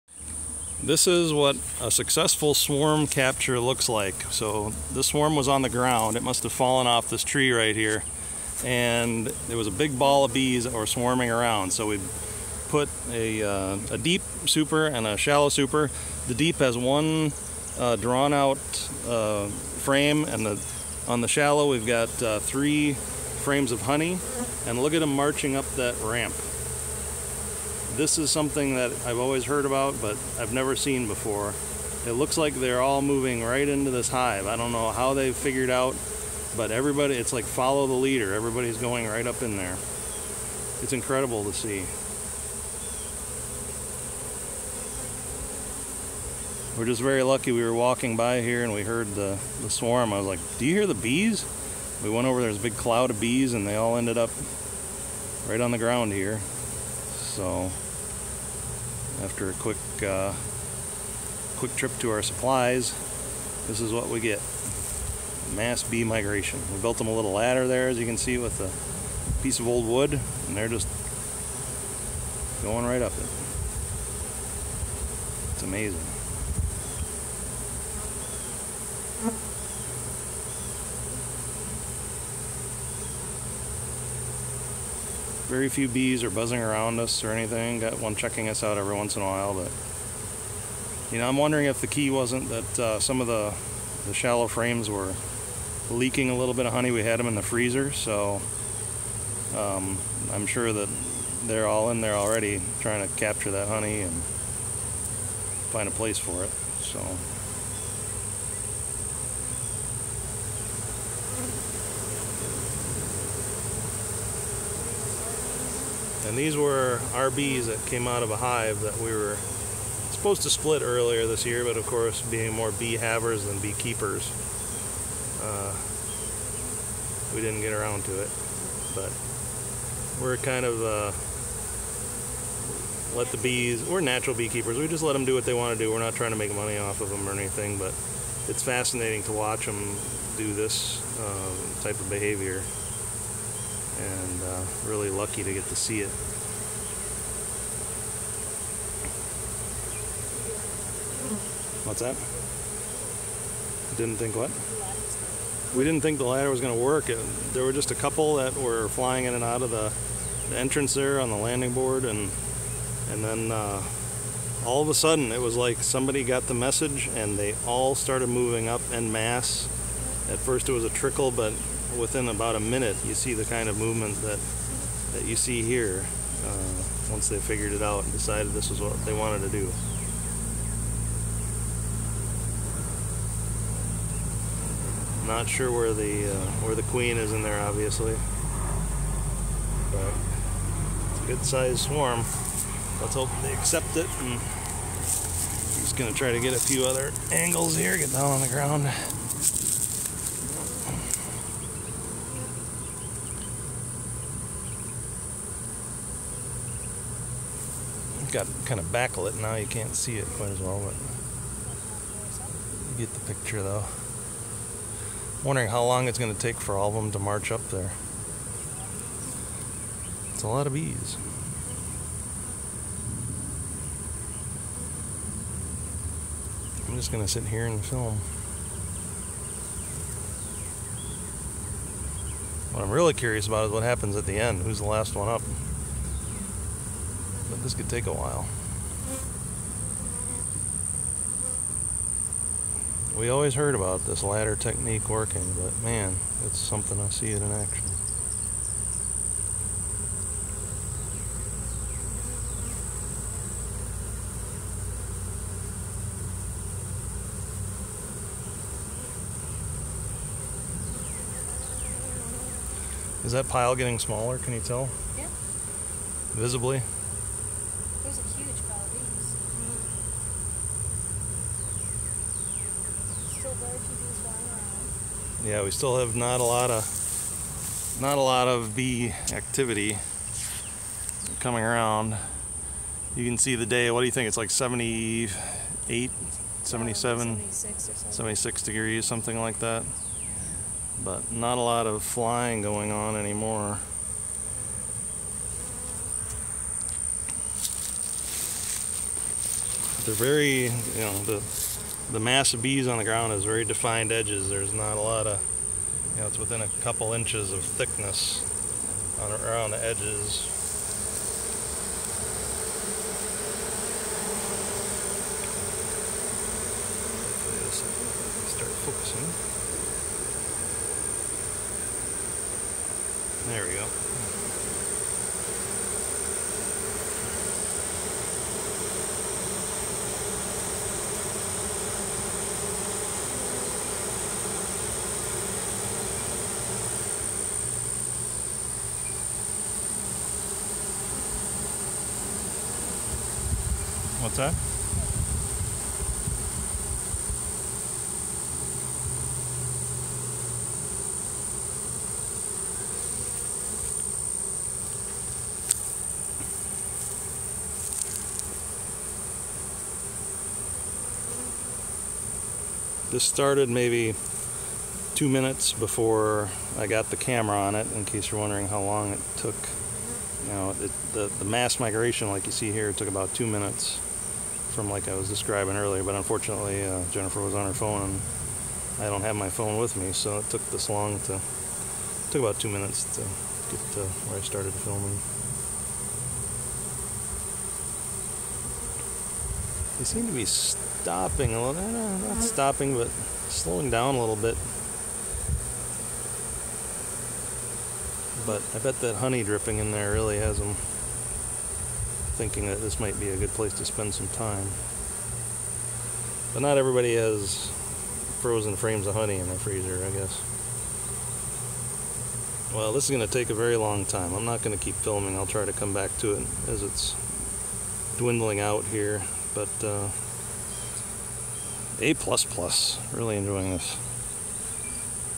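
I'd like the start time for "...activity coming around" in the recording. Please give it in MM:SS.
04:39.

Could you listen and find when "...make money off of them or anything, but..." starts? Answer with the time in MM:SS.
02:16.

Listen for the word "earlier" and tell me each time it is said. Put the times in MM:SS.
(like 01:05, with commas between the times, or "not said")
02:00, 06:15.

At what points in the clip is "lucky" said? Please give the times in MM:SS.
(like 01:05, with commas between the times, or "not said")
00:47, 02:25.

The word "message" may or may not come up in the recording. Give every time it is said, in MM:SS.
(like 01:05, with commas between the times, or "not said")
02:46.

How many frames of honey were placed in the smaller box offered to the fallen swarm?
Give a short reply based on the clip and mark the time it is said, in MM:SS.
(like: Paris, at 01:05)
3, at 00:22.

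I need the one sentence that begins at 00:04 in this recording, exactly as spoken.
So the swarm was on the ground.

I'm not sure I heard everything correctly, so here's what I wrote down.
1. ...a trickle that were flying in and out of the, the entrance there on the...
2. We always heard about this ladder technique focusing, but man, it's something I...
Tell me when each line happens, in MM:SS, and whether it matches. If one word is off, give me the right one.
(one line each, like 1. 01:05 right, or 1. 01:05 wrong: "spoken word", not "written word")
1. 02:37 wrong: "couple", not "trickle"
2. 04:03 wrong: "working", not "focusing".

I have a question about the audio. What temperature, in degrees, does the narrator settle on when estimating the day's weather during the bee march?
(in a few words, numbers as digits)
76.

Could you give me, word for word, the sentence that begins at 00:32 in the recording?
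It looks like they're all moving right into this hive.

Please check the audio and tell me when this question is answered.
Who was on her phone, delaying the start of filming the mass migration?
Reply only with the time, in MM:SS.
06:17.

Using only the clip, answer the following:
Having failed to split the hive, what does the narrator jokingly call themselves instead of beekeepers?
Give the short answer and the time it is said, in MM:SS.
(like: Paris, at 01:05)
bee havers, at 02:02.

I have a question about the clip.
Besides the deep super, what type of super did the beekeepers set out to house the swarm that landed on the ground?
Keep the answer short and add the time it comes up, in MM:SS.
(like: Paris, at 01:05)
shallow super, at 00:15.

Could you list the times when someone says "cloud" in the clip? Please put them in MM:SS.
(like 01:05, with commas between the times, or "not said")
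00:52.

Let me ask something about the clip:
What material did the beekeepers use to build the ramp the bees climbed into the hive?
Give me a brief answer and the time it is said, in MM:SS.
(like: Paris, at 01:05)
old wood, at 01:09.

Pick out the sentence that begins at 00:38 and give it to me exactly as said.
Everybody's going right up in there.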